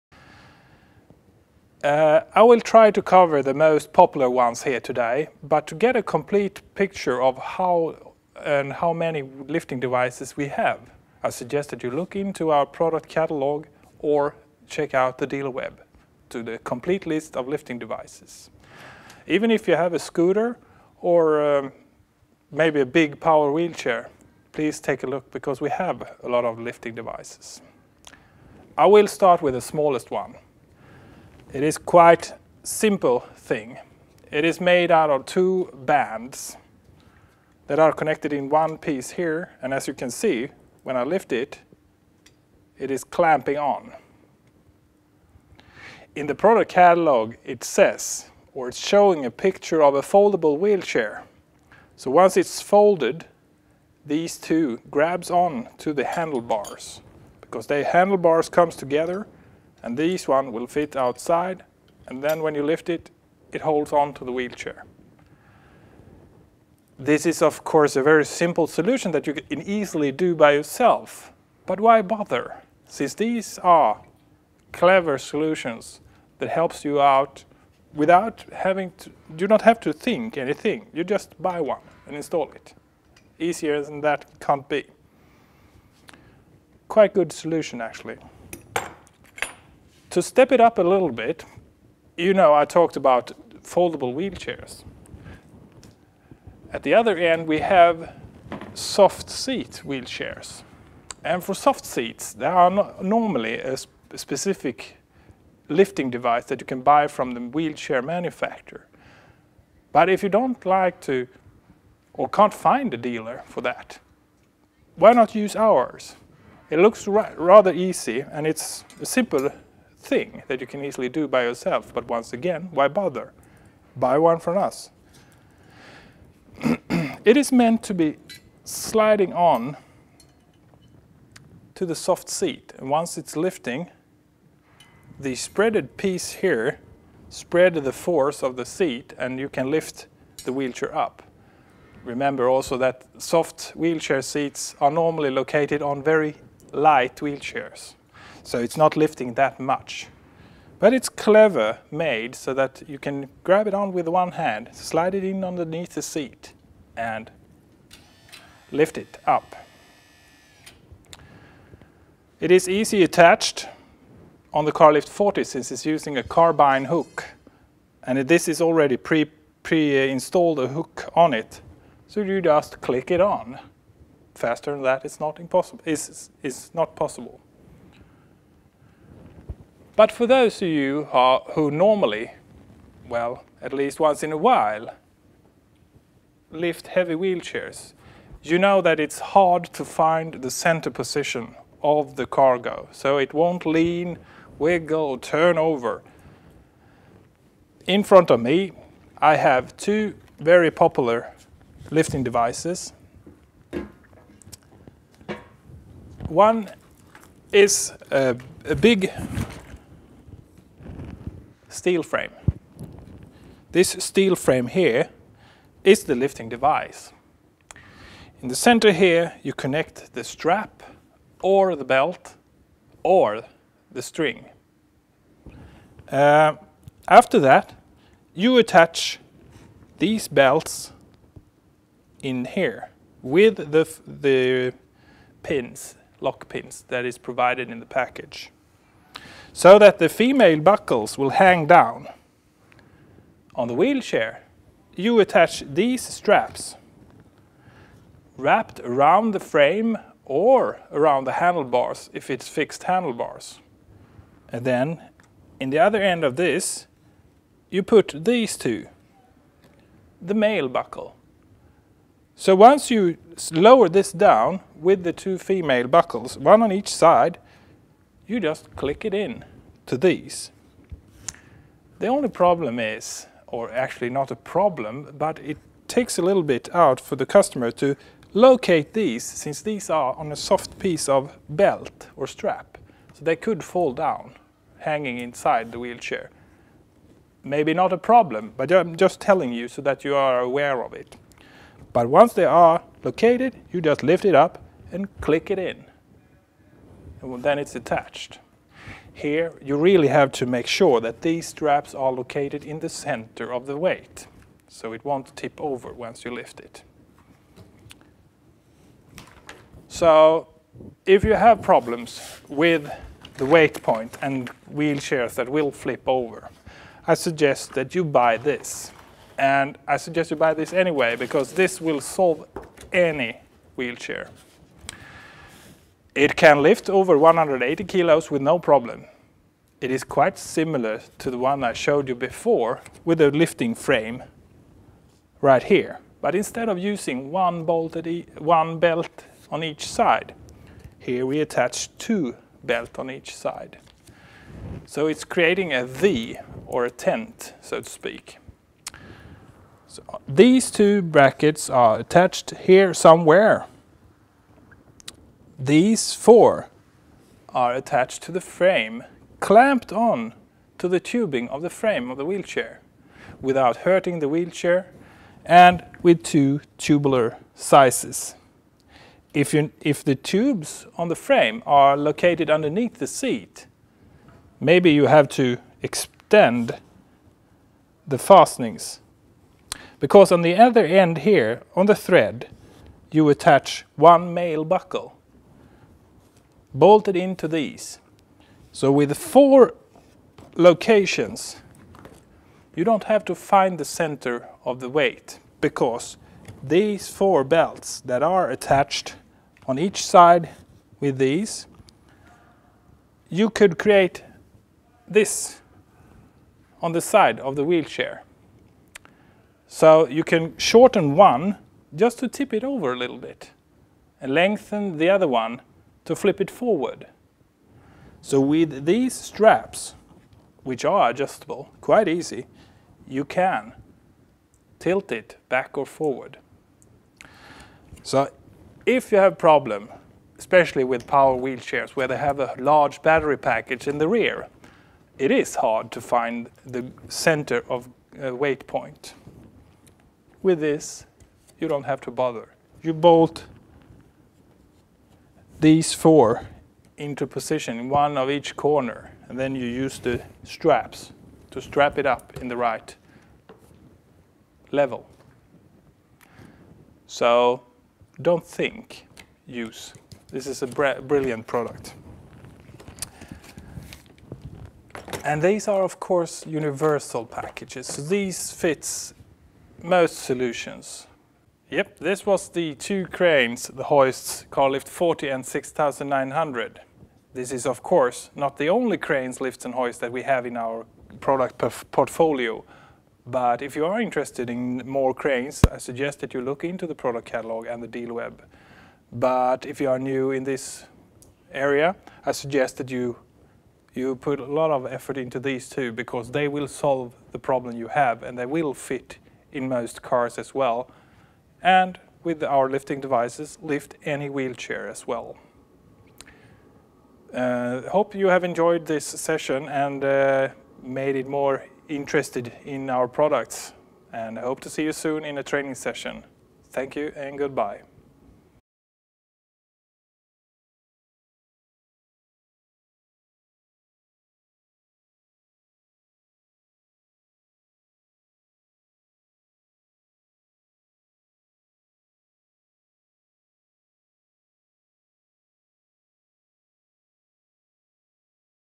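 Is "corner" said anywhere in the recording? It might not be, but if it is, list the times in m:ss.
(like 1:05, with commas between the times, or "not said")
7:28.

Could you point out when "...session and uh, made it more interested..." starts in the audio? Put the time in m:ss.
8:29.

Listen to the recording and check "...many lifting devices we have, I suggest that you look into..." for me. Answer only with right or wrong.
right.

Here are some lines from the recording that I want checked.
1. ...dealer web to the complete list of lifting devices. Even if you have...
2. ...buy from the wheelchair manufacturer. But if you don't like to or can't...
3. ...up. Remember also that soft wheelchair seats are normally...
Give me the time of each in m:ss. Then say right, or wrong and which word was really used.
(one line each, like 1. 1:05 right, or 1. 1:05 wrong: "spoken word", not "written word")
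1. 0:15 right
2. 1:46 right
3. 2:20 right.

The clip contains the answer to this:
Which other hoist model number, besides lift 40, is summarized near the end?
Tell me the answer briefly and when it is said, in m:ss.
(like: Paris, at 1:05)
6900, at 7:55.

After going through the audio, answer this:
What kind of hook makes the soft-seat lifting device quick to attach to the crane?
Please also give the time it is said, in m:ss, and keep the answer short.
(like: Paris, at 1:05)
Carbine hook, at 2:46.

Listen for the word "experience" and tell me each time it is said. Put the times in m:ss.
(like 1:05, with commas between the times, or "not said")
not said.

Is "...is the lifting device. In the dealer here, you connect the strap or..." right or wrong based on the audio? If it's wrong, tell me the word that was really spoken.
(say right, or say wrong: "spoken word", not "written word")
wrong: "center", not "dealer".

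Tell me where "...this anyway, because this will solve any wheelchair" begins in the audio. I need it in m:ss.
5:20.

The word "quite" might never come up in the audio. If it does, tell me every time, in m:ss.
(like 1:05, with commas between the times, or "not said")
0:31, 1:26, 5:30, 7:01.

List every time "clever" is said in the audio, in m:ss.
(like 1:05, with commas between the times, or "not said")
1:14, 2:31.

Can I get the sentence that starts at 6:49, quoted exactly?
So you can shorten one just to tip it over a little bit and lengthen the other one to flip it forward.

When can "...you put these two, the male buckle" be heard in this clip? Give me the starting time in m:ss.
4:17.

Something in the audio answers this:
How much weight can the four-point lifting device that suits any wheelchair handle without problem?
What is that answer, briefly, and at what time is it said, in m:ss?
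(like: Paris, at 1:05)
Over 180 kilos, at 5:26.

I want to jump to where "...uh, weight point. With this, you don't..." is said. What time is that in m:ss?
7:18.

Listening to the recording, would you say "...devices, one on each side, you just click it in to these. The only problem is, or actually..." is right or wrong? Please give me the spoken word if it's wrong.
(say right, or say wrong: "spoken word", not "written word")
wrong: "buckles", not "devices".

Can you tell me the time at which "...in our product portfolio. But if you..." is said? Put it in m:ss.
8:00.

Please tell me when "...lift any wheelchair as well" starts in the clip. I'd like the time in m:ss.
8:23.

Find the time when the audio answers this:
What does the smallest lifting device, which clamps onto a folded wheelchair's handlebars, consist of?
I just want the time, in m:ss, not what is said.
0:35.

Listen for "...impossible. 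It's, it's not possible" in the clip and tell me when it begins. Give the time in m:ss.
2:55.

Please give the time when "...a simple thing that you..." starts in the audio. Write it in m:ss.
1:58.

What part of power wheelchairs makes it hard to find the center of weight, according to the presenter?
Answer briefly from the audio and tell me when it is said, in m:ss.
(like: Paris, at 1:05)
Large battery package, at 7:12.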